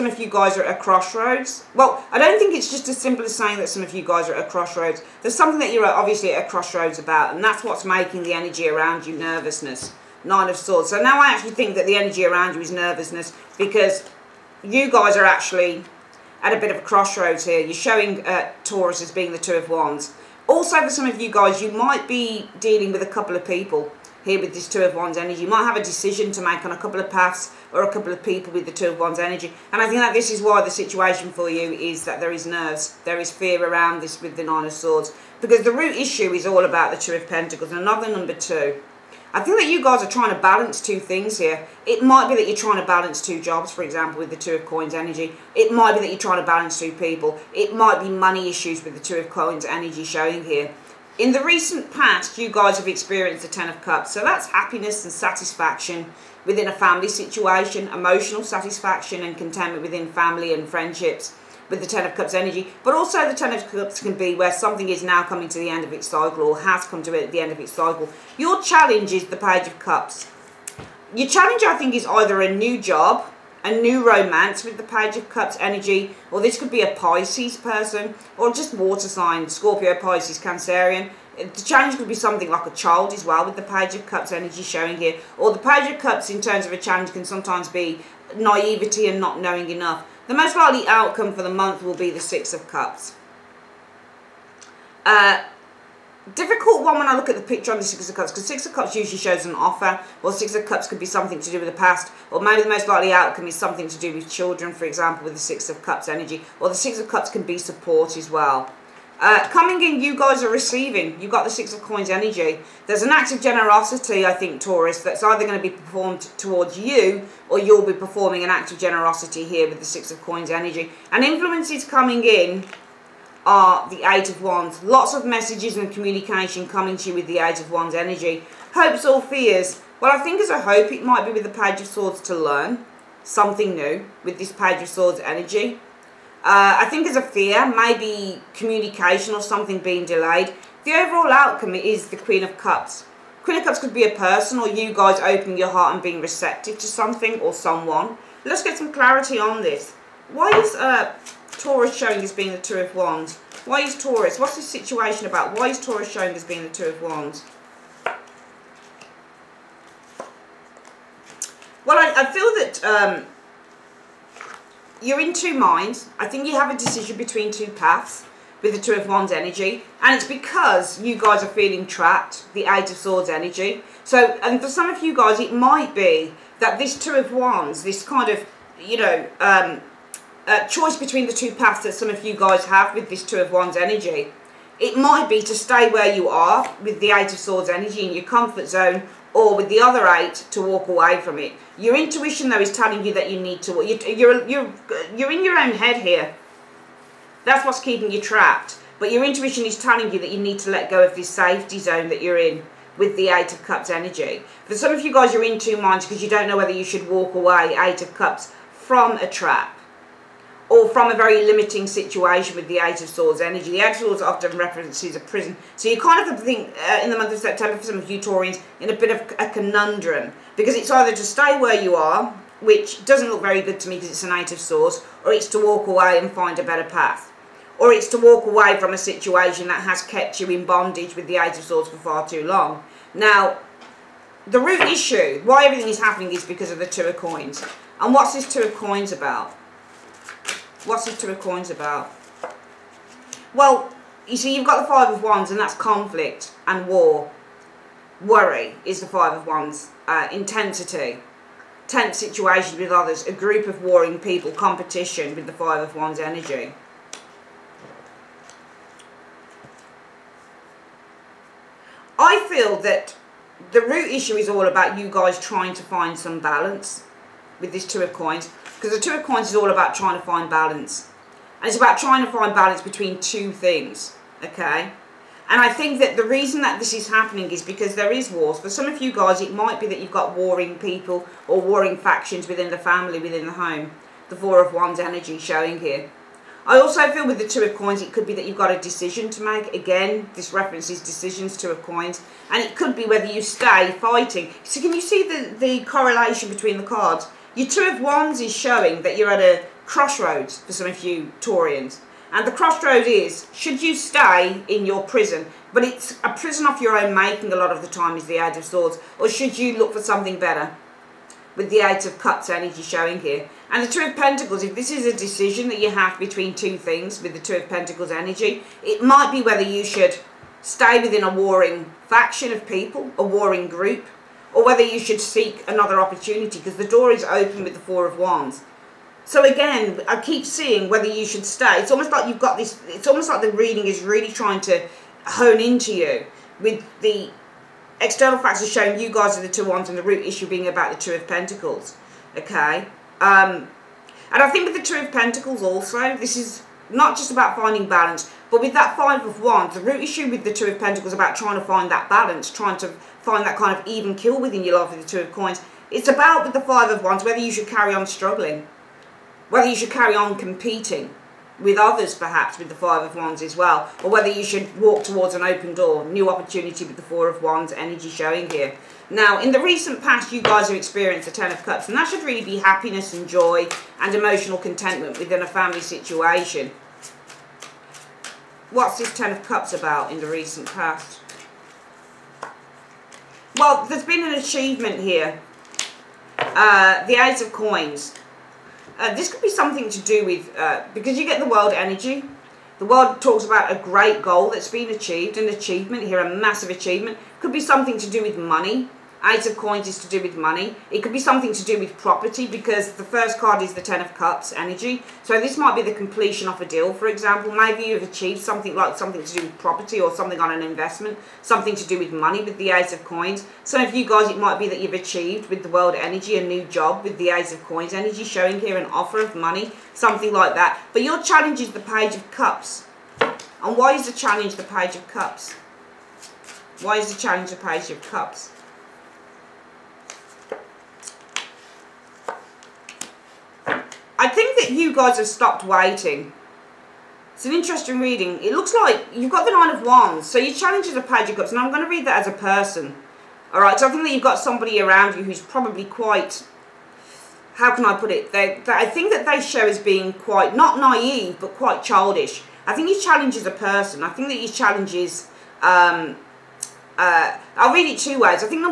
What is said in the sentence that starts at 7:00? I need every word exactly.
But your challenge is the Page of Cups.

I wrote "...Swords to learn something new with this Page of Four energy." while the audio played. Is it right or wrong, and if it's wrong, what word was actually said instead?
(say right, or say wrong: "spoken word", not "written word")
wrong: "Swords", not "Four".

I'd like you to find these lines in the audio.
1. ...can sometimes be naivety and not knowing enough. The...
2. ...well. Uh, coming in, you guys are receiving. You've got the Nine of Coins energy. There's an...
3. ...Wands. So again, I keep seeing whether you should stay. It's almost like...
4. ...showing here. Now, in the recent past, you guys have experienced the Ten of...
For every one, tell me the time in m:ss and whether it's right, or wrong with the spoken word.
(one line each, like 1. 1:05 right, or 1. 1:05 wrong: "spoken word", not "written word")
1. 1:27 right
2. 1:48 wrong: "Six", not "Nine"
3. 5:28 right
4. 6:08 right.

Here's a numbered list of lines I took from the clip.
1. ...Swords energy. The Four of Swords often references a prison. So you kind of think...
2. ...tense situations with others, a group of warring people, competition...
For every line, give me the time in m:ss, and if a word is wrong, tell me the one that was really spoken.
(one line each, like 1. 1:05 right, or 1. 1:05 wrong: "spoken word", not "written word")
1. 3:33 wrong: "Eight", not "Four"
2. 4:11 right.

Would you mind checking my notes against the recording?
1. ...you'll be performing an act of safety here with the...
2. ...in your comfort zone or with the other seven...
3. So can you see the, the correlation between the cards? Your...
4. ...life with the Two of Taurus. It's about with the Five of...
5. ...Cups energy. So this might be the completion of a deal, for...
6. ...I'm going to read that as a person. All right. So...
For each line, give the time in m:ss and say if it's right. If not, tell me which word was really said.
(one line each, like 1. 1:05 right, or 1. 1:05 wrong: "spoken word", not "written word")
1. 1:57 wrong: "generosity", not "safety"
2. 3:08 wrong: "eight", not "seven"
3. 4:54 right
4. 5:54 wrong: "Coins", not "Taurus"
5. 6:44 right
6. 7:21 right.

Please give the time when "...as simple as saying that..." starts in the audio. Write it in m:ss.
0:02.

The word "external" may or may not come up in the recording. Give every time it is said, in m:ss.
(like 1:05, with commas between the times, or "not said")
5:38.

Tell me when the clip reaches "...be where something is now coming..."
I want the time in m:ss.
1:04.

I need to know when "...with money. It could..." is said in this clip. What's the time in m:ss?
6:40.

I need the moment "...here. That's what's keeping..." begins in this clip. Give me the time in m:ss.
3:16.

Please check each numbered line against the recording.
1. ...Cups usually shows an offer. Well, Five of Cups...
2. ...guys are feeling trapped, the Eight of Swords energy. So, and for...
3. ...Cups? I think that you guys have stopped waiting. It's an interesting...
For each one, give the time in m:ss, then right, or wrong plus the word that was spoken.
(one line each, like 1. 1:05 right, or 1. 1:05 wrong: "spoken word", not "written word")
1. 1:38 wrong: "Six", not "Five"
2. 2:51 right
3. 7:08 right.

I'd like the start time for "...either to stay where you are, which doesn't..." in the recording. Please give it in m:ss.
3:40.